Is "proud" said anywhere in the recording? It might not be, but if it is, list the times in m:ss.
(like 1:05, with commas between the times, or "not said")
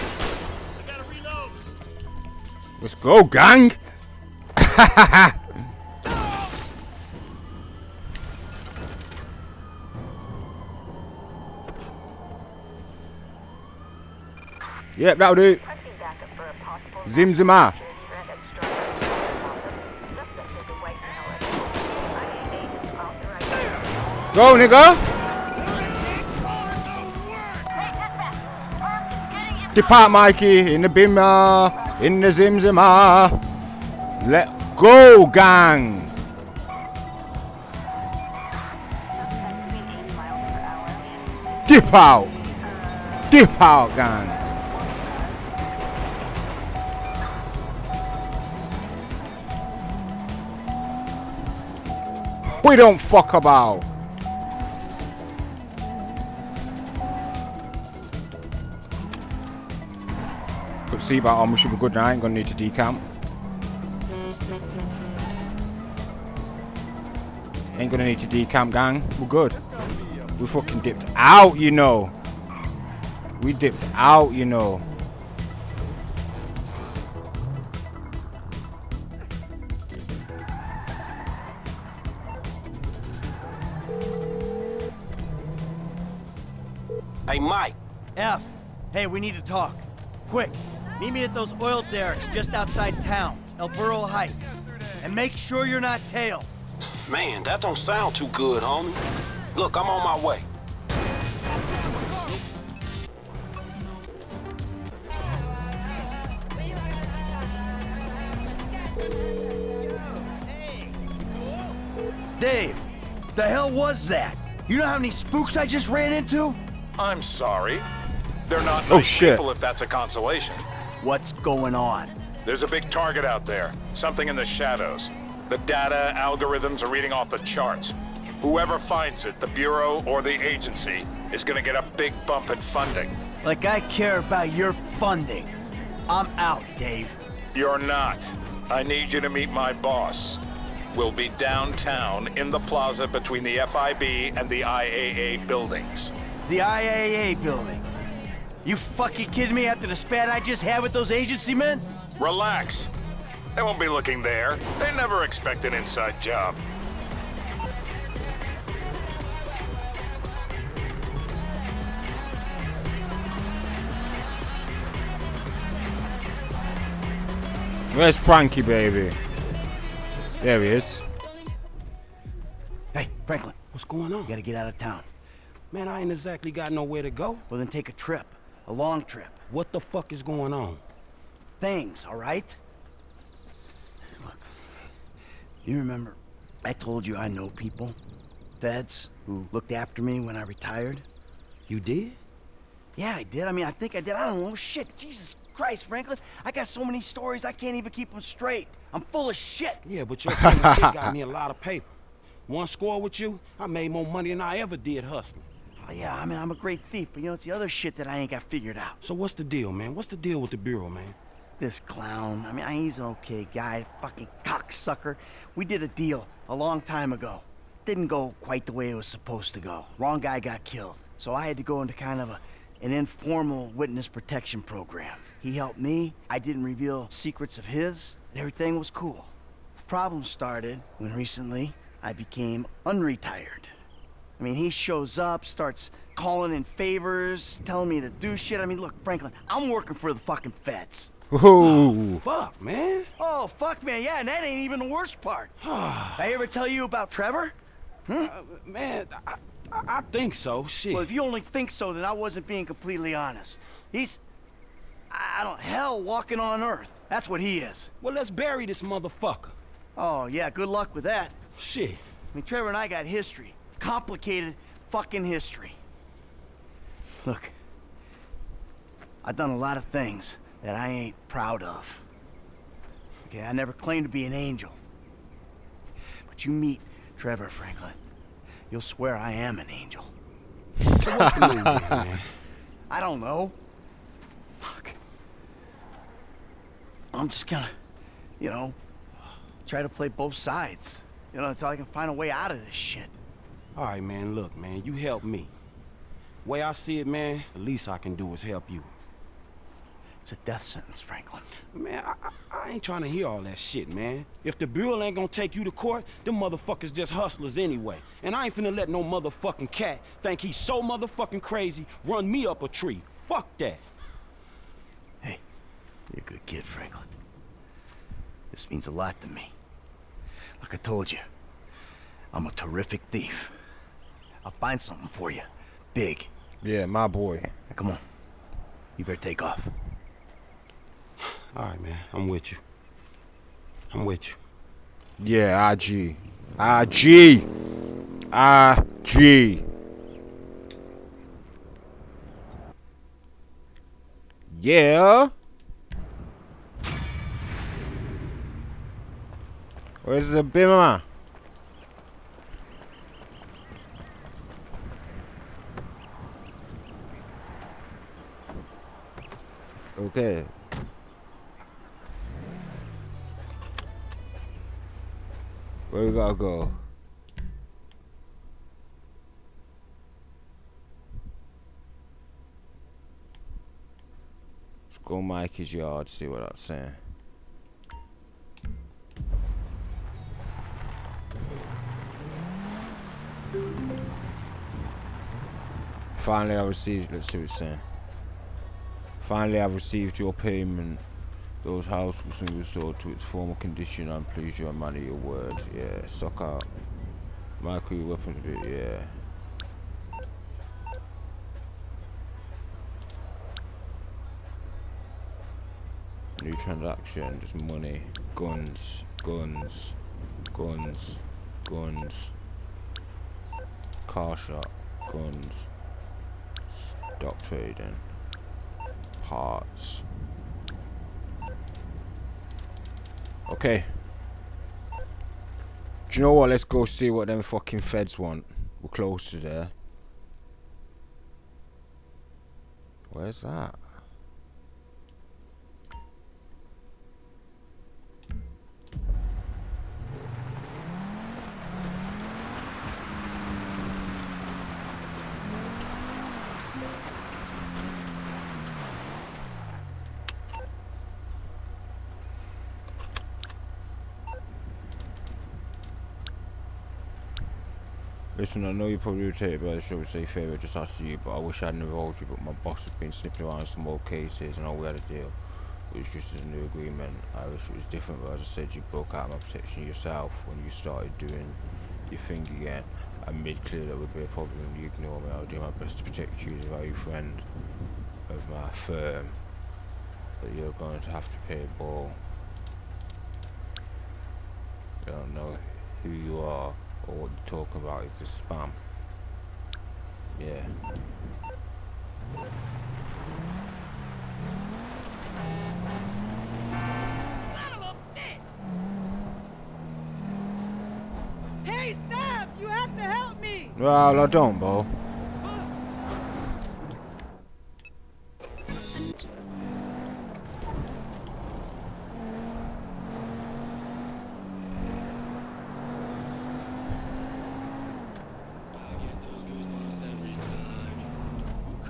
4:31.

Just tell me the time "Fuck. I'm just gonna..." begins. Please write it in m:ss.
4:44.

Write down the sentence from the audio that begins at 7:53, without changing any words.
I made clear that would be a problem and you ignore me.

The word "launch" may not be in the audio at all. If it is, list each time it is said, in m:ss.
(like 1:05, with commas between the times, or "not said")
not said.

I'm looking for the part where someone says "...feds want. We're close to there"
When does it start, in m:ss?
7:07.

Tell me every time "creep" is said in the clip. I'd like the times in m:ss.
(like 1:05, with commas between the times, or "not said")
not said.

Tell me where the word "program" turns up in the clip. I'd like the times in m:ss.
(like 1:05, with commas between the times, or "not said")
3:44.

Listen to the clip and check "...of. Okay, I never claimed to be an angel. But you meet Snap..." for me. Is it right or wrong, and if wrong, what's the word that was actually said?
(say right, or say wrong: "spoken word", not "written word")
wrong: "Trevor", not "Snap".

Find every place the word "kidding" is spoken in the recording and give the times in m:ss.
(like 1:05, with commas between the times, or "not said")
2:29.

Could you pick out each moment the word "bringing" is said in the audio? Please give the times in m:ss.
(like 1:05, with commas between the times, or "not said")
not said.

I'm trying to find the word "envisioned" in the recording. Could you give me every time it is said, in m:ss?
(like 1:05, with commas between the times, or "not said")
not said.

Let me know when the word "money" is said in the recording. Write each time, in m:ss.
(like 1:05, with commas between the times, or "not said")
3:24, 6:47.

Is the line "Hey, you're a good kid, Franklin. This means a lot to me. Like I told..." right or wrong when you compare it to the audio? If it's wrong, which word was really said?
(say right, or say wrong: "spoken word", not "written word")
right.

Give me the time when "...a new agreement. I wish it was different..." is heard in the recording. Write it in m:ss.
7:46.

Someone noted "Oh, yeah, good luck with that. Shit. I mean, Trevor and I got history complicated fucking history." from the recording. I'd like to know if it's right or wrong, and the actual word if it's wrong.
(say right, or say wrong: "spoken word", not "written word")
right.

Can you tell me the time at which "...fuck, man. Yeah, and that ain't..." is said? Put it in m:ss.
4:03.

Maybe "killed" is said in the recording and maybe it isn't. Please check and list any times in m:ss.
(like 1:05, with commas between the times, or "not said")
3:40.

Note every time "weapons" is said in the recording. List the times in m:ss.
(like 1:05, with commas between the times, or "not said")
6:37.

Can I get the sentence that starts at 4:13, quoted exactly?
He's, I don't, hell walking on Earth.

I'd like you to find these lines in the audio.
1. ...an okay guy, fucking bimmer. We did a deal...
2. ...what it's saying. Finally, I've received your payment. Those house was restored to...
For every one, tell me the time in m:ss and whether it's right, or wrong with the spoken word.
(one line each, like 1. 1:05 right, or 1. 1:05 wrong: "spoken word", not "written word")
1. 3:32 wrong: "cocksucker", not "bimmer"
2. 6:27 right.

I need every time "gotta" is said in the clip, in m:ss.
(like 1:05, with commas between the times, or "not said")
2:54, 6:06.